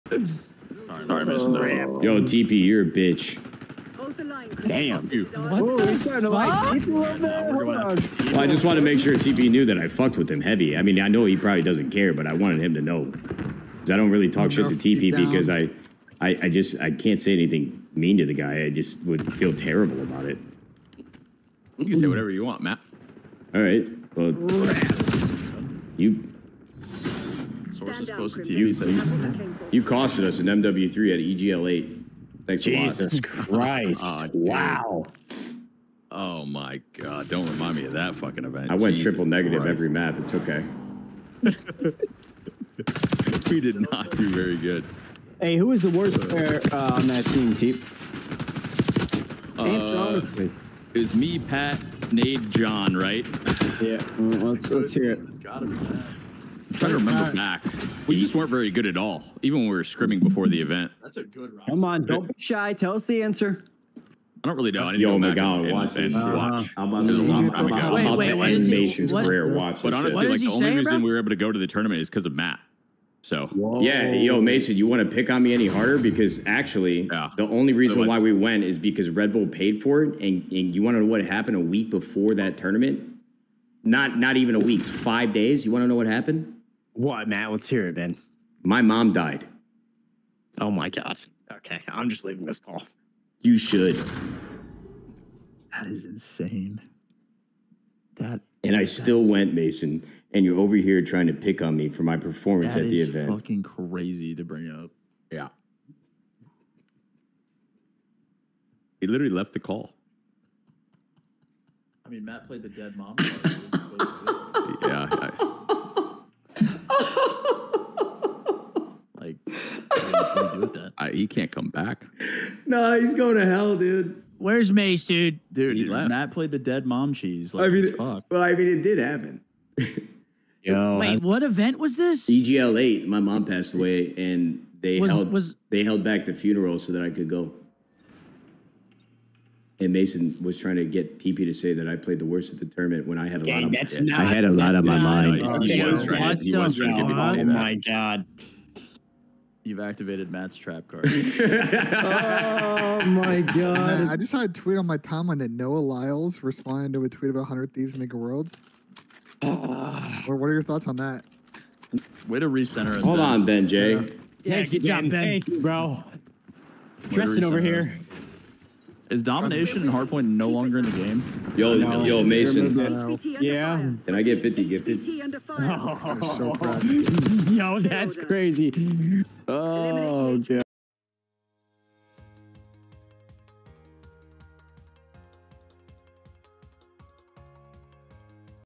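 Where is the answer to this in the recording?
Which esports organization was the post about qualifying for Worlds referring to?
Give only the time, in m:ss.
2:37.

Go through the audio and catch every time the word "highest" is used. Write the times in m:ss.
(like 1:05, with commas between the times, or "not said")
not said.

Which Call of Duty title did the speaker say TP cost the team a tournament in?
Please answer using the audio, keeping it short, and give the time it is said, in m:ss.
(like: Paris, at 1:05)
MW3, at 0:30.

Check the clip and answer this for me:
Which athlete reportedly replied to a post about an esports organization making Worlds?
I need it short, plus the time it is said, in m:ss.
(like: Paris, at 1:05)
Noah Lyles, at 2:35.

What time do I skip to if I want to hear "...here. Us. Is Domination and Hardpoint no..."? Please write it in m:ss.
2:47.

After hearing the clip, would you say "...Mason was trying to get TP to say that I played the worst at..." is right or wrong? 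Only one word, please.
right.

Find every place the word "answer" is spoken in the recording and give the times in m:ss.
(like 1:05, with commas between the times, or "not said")
0:49, 1:03.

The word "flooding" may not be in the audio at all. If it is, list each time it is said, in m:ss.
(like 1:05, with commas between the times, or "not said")
not said.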